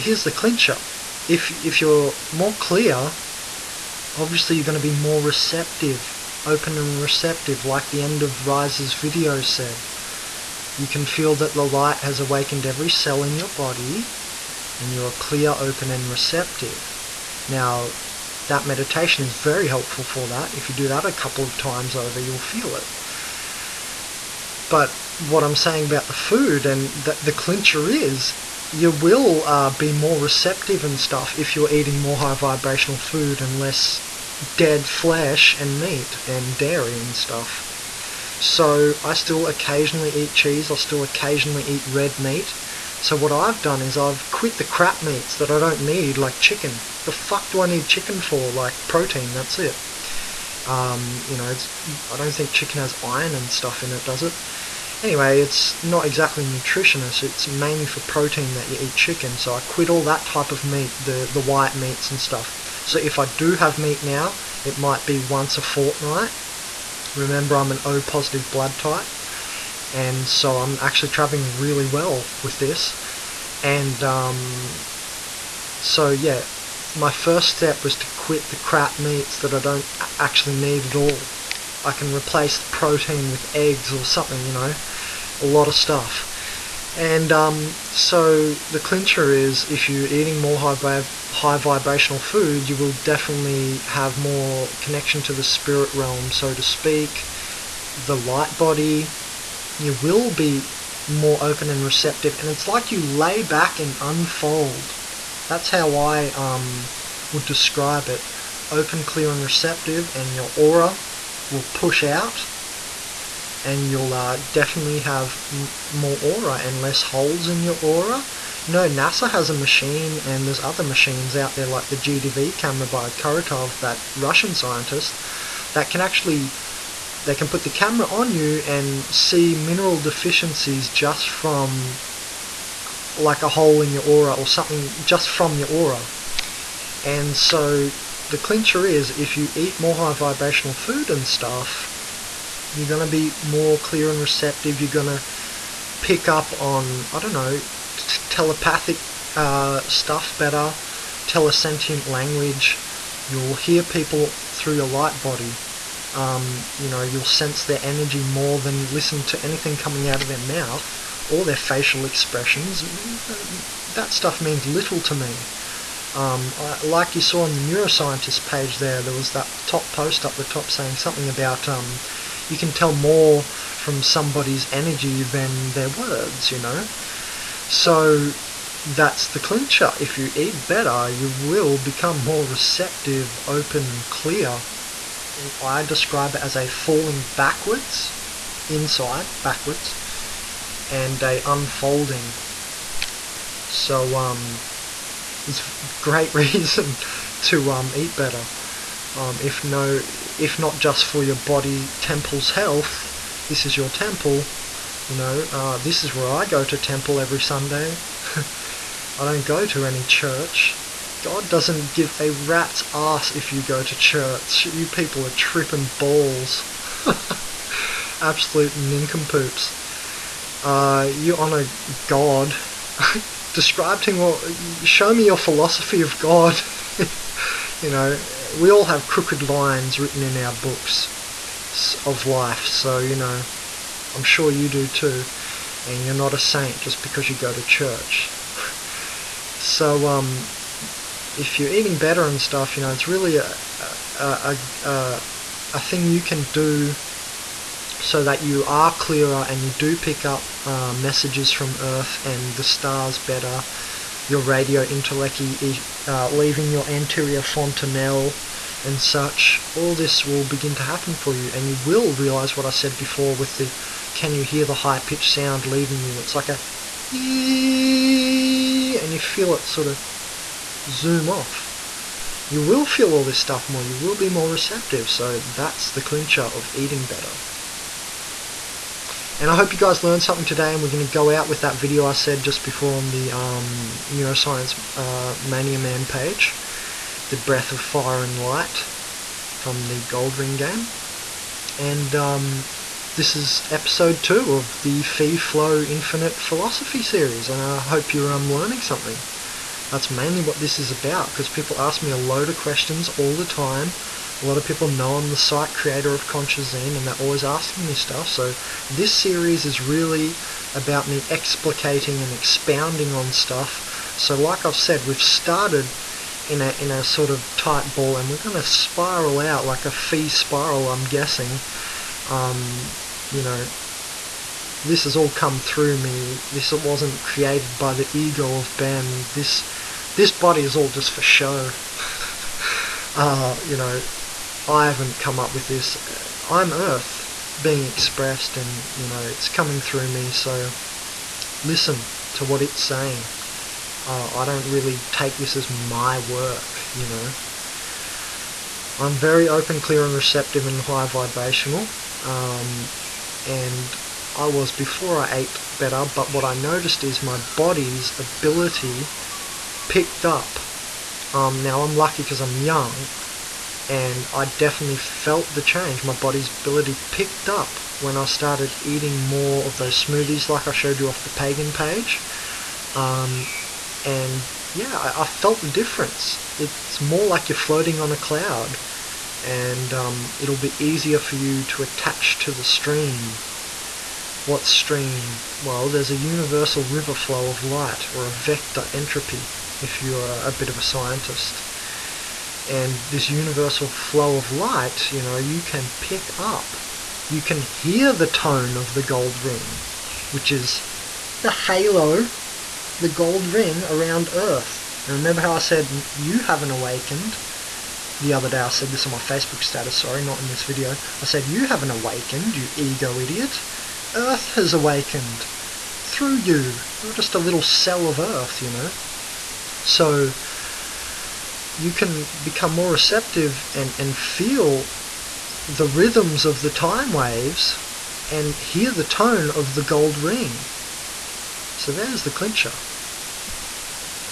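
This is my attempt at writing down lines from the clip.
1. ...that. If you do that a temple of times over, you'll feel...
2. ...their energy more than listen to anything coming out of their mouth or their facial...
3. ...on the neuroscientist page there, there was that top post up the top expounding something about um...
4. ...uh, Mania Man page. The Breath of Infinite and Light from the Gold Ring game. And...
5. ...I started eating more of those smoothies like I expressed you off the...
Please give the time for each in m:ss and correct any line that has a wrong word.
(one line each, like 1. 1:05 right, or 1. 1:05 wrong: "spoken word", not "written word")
1. 0:20 wrong: "couple", not "temple"
2. 2:37 right
3. 2:47 wrong: "saying", not "expounding"
4. 4:44 wrong: "Fire", not "Infinite"
5. 6:08 wrong: "showed", not "expressed".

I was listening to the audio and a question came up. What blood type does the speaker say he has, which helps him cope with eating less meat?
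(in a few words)
O positive.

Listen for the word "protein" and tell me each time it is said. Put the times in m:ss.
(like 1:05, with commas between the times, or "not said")
0:48, 0:58, 1:22.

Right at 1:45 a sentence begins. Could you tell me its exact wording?
That's how I um, would describe it.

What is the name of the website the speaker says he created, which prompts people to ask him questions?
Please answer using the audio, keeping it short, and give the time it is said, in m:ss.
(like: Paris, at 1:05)
Consciousazine, at 5:06.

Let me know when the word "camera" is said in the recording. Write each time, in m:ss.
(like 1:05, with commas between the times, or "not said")
2:02, 2:07.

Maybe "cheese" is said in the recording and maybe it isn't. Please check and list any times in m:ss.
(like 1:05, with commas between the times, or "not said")
0:40.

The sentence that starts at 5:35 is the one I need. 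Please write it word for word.
Uh, I'm Earth being expressed, and you know, it's coming through me.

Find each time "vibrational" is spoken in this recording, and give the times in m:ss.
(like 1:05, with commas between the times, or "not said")
0:32, 1:31, 2:20, 5:51.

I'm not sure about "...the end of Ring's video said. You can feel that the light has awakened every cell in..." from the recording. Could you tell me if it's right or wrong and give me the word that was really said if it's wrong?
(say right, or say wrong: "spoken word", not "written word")
wrong: "Rise", not "Ring".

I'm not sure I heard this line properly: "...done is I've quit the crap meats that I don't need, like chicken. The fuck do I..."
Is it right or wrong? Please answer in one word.
right.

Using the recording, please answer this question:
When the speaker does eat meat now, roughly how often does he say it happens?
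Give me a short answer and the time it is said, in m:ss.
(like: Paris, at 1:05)
Once a fortnight, at 1:05.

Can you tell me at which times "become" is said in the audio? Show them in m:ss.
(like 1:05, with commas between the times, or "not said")
3:01, 7:02.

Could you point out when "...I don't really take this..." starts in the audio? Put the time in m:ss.
5:44.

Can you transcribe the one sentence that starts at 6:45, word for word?
And remember how I said you haven't awakened?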